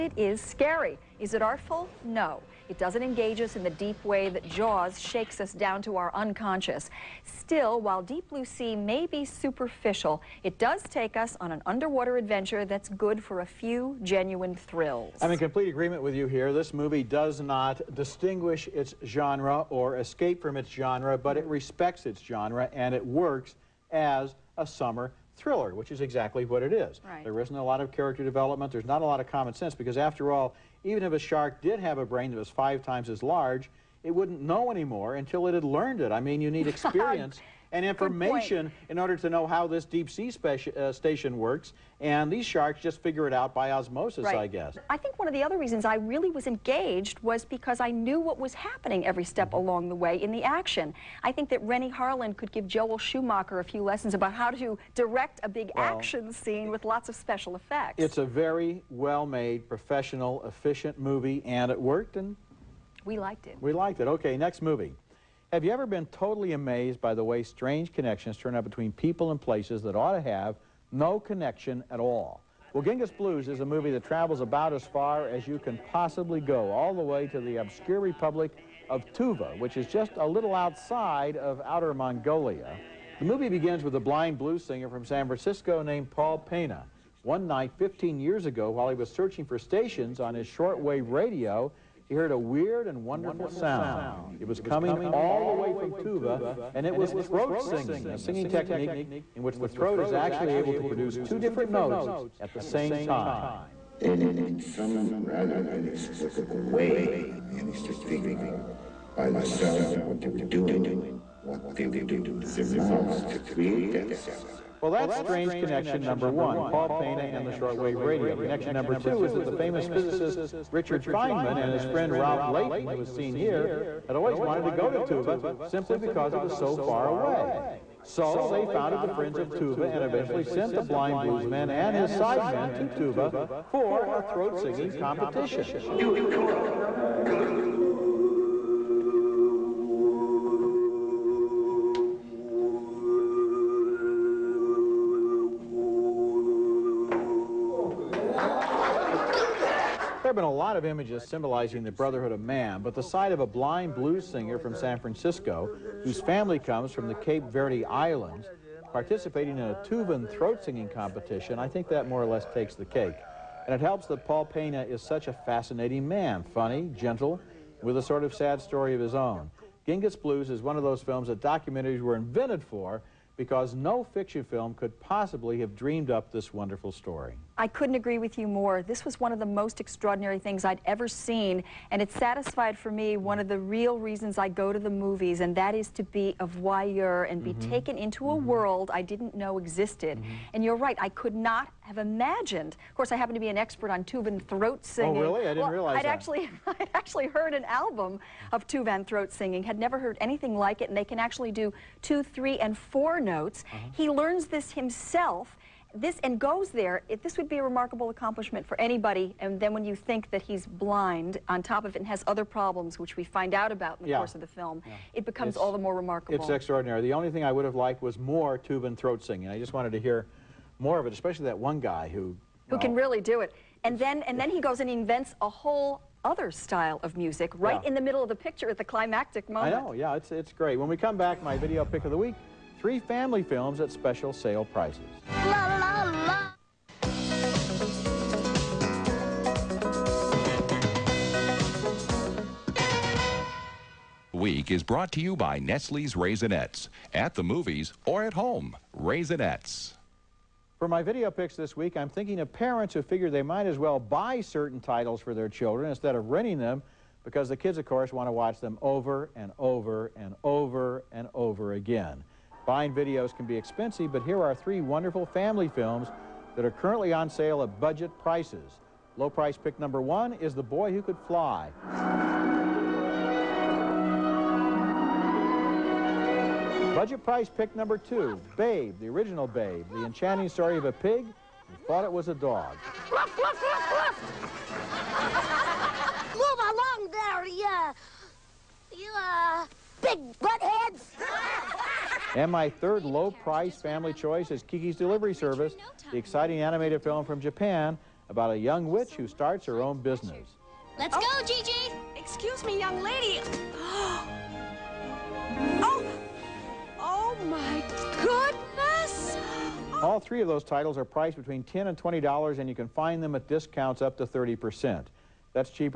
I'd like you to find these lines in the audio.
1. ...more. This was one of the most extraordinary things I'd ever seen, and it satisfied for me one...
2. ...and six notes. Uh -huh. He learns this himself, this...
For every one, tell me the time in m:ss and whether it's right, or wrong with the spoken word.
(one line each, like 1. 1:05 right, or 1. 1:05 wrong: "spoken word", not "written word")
1. 2:58 right
2. 3:22 wrong: "four", not "six".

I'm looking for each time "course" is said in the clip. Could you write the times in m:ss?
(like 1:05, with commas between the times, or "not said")
3:12, 3:34, 4:17.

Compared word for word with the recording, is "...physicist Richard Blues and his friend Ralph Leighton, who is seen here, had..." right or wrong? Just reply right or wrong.
wrong.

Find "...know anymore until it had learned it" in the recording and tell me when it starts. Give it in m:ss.
0:34.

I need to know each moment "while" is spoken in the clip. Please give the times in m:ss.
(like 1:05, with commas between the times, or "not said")
0:07, 1:28.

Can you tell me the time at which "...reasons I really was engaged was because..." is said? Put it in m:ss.
0:45.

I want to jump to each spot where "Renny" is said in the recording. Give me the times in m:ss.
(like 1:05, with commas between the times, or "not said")
0:51.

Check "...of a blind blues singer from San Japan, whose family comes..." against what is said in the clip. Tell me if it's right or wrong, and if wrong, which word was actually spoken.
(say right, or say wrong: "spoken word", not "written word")
wrong: "Francisco", not "Japan".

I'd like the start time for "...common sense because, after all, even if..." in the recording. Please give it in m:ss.
0:29.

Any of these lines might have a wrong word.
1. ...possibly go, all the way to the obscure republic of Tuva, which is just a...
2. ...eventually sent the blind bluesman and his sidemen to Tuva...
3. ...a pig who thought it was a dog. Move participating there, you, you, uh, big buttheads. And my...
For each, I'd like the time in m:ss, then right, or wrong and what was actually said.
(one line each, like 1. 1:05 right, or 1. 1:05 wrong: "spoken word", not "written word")
1. 1:15 right
2. 2:10 right
3. 4:40 wrong: "along", not "participating".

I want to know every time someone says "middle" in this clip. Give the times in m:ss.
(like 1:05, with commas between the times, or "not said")
3:48.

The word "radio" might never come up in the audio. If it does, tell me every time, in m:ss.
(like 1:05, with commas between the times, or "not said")
1:31, 1:58.